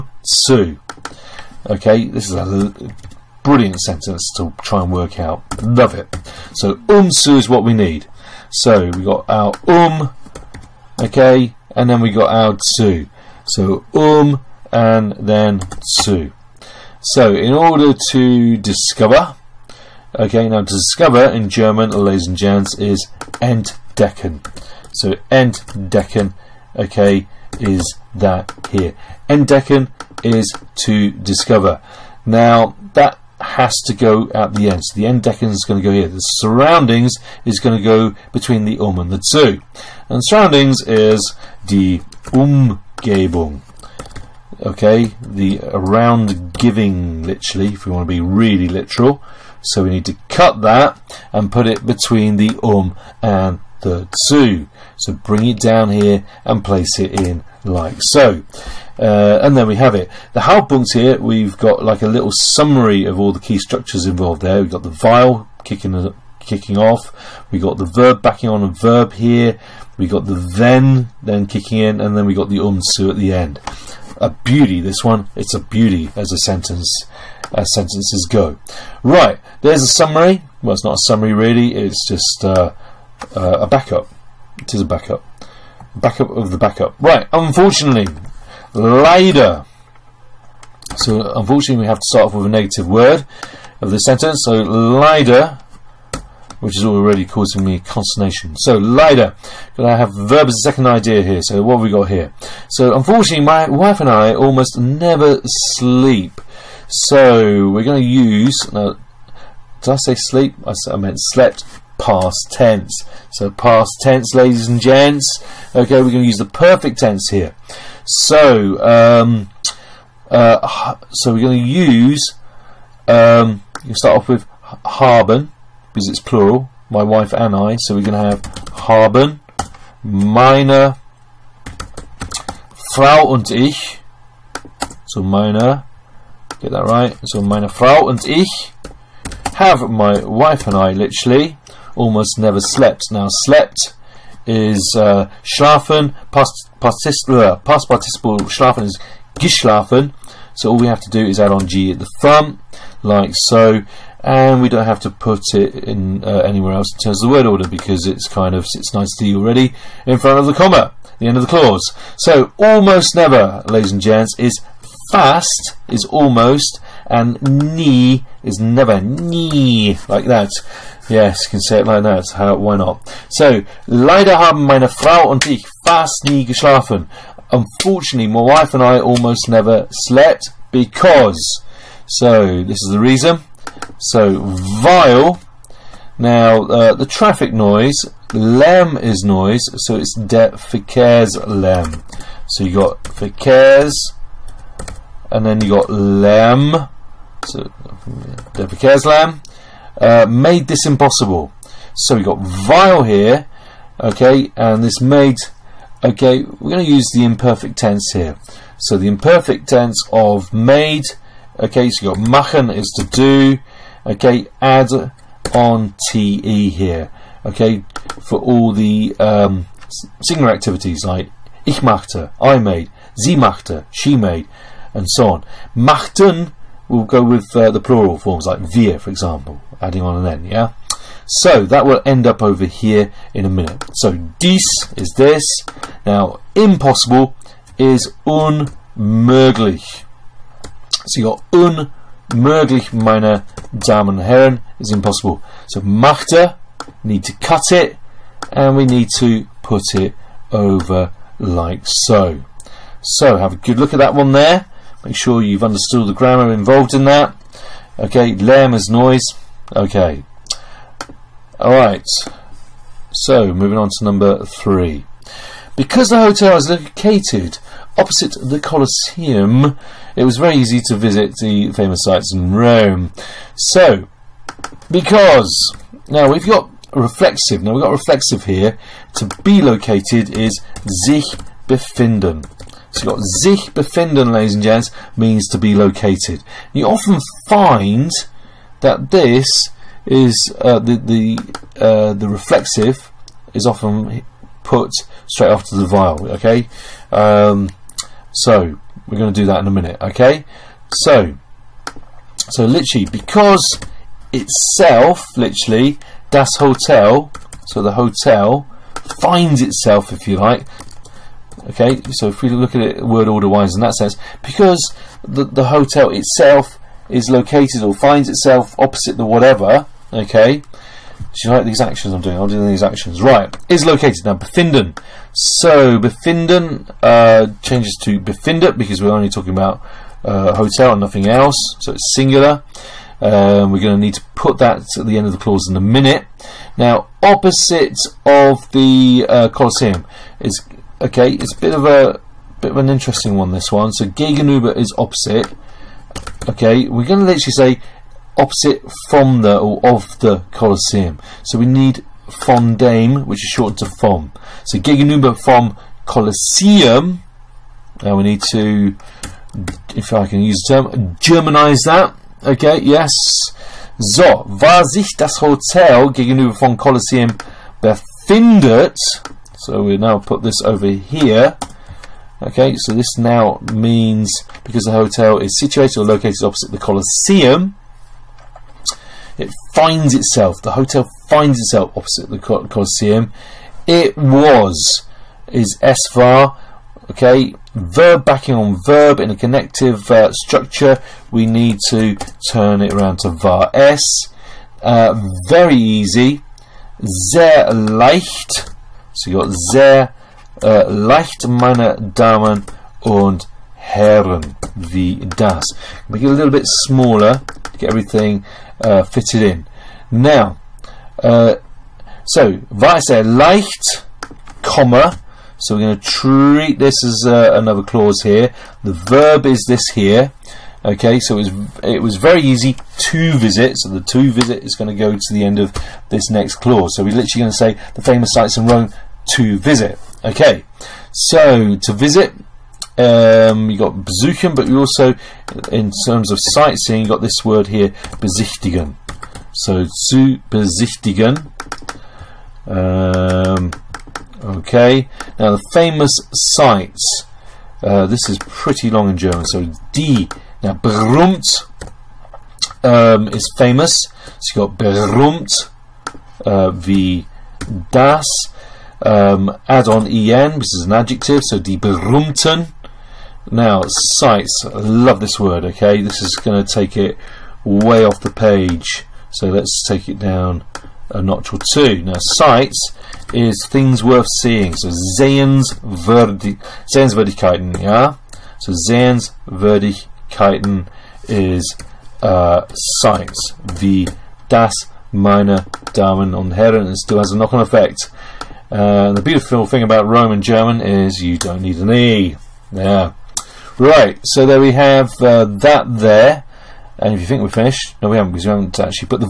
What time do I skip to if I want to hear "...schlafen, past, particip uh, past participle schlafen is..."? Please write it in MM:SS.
02:25.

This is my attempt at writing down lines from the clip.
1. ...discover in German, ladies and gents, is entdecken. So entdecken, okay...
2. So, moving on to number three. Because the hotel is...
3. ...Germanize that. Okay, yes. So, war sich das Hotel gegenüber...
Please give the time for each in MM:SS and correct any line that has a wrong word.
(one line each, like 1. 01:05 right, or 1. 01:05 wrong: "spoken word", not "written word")
1. 00:20 right
2. 04:23 right
3. 06:01 right.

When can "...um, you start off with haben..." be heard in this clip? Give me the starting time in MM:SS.
02:03.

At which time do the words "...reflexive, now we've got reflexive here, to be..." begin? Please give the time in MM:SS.
04:36.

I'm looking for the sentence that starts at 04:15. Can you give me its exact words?
Make sure you've understood the grammar involved in that.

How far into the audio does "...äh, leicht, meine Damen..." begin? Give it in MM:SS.
06:40.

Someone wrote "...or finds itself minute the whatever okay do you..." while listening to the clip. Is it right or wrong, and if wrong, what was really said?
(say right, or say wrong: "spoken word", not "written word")
wrong: "opposite", not "minute".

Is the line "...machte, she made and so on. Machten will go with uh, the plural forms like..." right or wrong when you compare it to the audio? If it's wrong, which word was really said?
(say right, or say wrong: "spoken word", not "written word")
right.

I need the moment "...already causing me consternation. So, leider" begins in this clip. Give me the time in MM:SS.
01:36.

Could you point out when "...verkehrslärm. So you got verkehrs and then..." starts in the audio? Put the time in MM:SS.
03:10.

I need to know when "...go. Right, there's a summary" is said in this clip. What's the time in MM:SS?
01:18.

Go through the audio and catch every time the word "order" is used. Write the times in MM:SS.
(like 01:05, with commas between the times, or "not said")
00:17, 02:37, 05:13.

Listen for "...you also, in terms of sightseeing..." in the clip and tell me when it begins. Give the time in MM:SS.
07:14.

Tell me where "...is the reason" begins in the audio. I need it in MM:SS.
03:02.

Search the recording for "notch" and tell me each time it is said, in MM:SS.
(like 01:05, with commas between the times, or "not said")
07:51.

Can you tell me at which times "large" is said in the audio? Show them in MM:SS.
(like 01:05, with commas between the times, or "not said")
not said.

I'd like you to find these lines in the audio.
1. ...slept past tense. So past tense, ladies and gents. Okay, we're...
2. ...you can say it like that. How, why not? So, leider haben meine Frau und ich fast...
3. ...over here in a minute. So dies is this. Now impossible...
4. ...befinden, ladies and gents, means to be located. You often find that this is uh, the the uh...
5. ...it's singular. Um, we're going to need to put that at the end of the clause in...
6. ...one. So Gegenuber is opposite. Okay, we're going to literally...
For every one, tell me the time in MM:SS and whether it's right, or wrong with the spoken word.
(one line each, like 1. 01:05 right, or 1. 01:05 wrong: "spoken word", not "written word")
1. 01:51 right
2. 02:51 right
3. 03:52 right
4. 04:43 right
5. 05:31 right
6. 05:43 right.